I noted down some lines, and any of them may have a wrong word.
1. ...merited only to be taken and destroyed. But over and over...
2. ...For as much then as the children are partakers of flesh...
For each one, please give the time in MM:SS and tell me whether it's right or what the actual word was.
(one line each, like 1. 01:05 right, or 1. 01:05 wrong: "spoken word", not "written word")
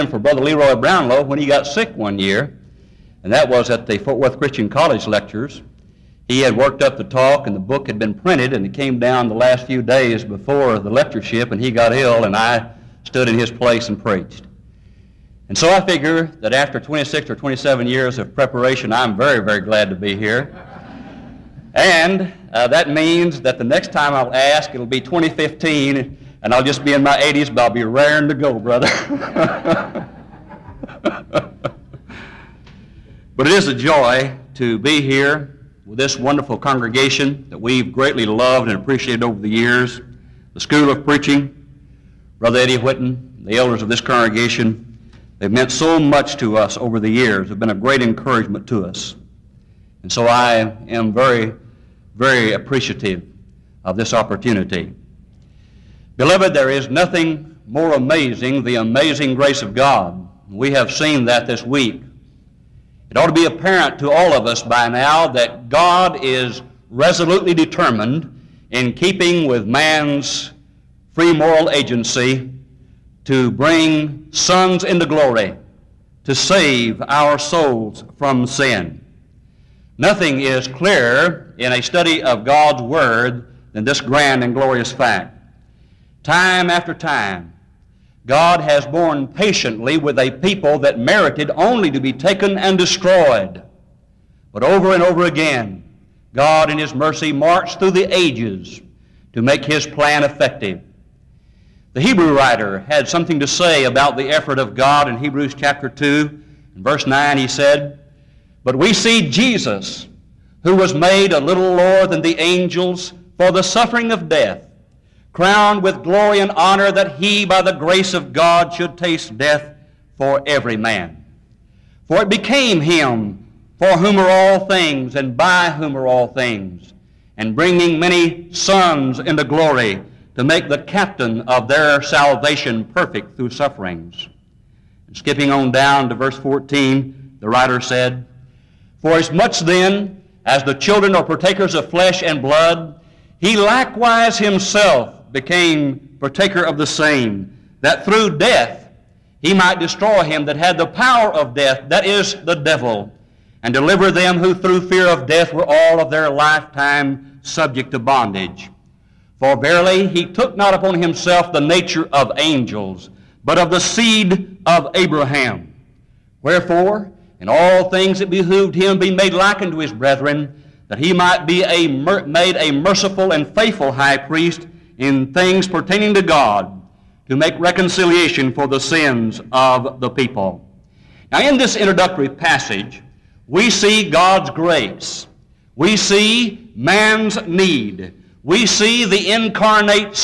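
1. 01:30 right
2. 02:19 right.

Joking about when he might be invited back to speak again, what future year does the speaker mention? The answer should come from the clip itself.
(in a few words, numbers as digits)
2015.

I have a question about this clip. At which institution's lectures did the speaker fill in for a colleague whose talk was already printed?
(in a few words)
Fort Worth Christian College.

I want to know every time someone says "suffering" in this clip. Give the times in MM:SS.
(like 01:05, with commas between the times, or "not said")
01:53, 02:13.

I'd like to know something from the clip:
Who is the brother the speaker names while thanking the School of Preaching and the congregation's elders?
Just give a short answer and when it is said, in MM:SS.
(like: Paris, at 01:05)
Eddie Whitten, at 00:42.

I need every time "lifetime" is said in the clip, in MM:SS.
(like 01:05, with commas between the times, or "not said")
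02:36.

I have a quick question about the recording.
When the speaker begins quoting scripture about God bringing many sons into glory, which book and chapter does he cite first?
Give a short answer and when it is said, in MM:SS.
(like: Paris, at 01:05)
Hebrews chapter 2, at 01:45.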